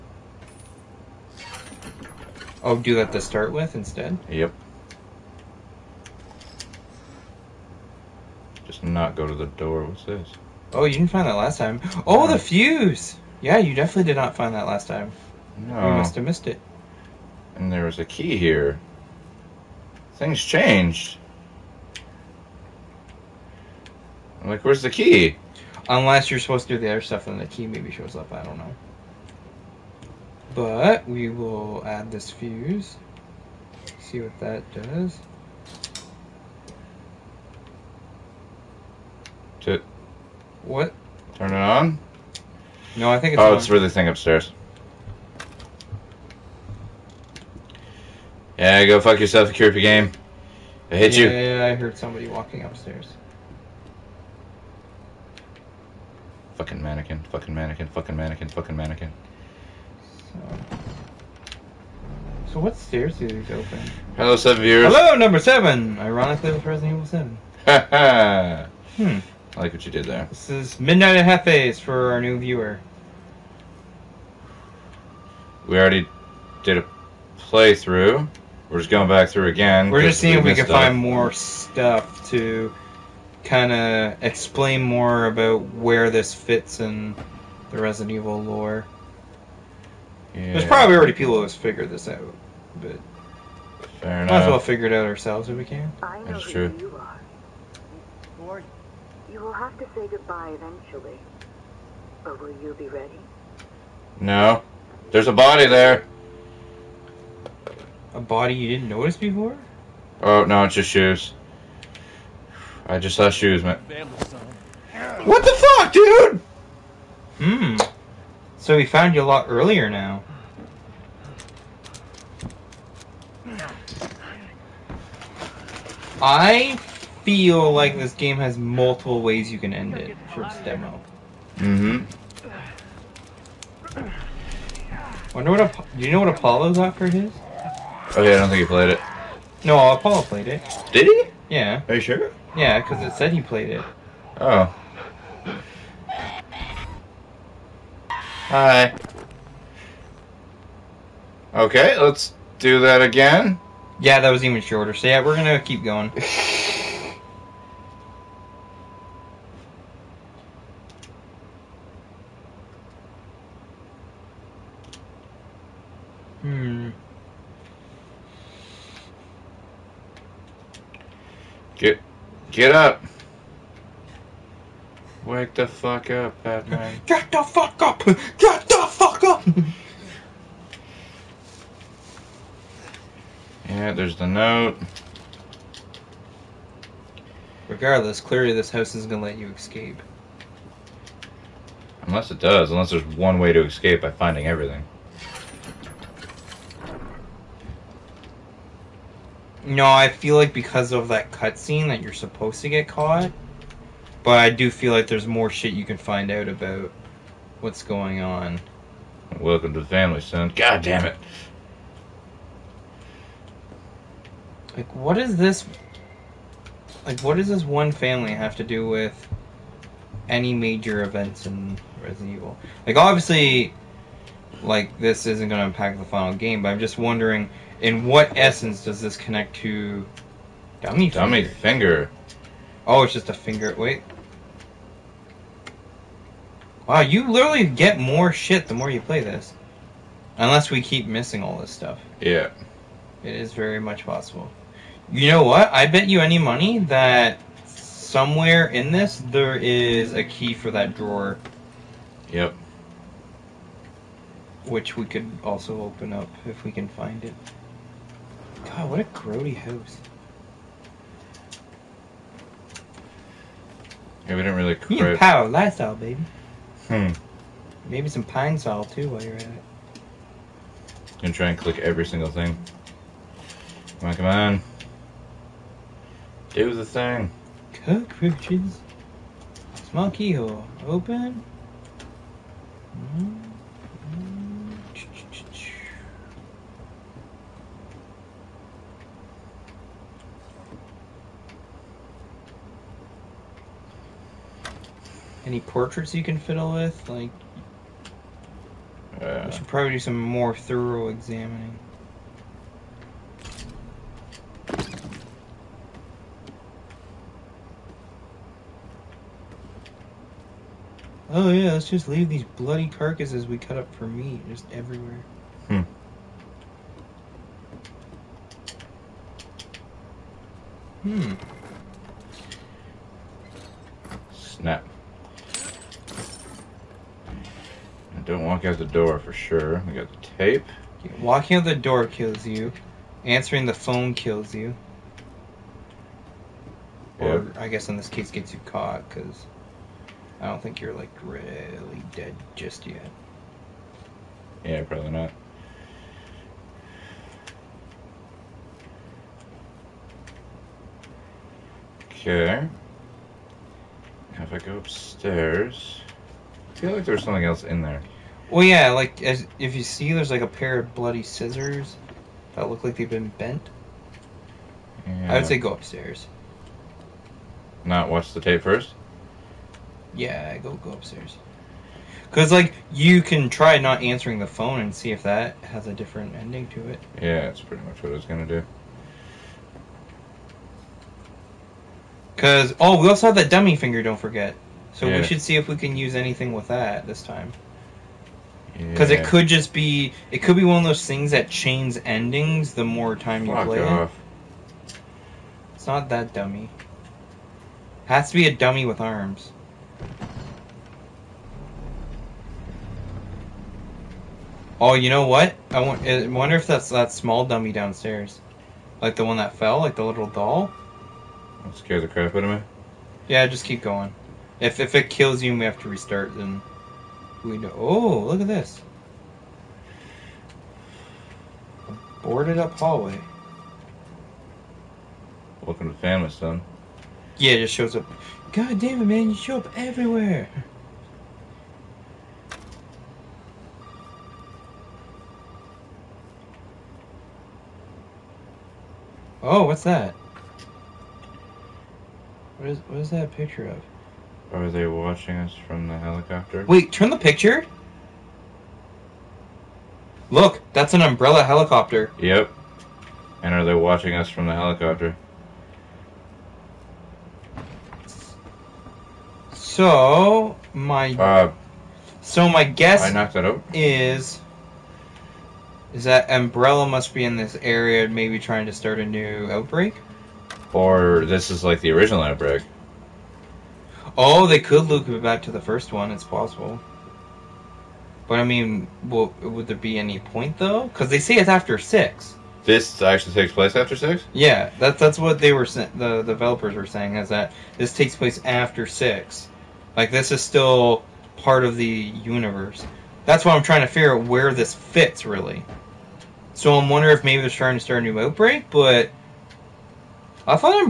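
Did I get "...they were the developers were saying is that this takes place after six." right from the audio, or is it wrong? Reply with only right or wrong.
right.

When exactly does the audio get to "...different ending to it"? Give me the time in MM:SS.
06:15.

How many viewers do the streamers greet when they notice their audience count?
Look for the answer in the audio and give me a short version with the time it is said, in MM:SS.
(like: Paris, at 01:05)
7, at 01:04.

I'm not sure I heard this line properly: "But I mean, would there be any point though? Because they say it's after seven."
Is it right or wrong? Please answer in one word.
wrong.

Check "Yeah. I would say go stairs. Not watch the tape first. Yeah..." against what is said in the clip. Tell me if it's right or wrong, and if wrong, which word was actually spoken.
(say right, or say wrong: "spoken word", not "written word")
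wrong: "upstairs", not "stairs".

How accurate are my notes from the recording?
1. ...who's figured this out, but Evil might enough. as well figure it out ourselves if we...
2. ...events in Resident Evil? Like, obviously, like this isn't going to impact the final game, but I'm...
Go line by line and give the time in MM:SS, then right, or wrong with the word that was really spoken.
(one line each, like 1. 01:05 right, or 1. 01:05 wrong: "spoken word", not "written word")
1. 01:31 wrong: "Fair", not "Evil"
2. 03:41 right.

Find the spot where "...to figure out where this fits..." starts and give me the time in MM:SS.
08:13.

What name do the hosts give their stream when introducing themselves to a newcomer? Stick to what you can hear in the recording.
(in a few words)
Midnight at Hef-A's.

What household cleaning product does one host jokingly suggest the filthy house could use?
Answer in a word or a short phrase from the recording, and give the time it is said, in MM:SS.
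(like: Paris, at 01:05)
Pine-Sol, at 04:28.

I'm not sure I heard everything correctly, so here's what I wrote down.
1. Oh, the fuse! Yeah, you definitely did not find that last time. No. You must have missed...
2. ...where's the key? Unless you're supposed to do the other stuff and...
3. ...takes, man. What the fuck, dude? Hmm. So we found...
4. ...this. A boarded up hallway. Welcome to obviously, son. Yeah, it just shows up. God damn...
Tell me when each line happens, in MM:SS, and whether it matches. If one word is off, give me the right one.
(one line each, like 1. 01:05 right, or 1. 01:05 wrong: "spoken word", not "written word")
1. 00:12 right
2. 00:24 right
3. 01:53 wrong: "shoes", not "takes"
4. 06:58 wrong: "family", not "obviously".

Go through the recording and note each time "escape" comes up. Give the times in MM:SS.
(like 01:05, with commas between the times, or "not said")
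03:09, 03:13.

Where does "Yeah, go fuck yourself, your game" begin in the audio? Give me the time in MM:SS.
00:48.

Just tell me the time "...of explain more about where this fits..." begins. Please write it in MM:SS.
01:23.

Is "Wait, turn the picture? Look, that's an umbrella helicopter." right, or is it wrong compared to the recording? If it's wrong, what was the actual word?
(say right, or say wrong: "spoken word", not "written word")
right.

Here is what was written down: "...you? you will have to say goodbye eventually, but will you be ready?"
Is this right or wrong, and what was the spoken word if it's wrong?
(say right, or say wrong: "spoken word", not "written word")
right.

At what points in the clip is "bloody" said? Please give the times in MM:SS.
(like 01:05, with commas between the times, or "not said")
05:12, 06:00.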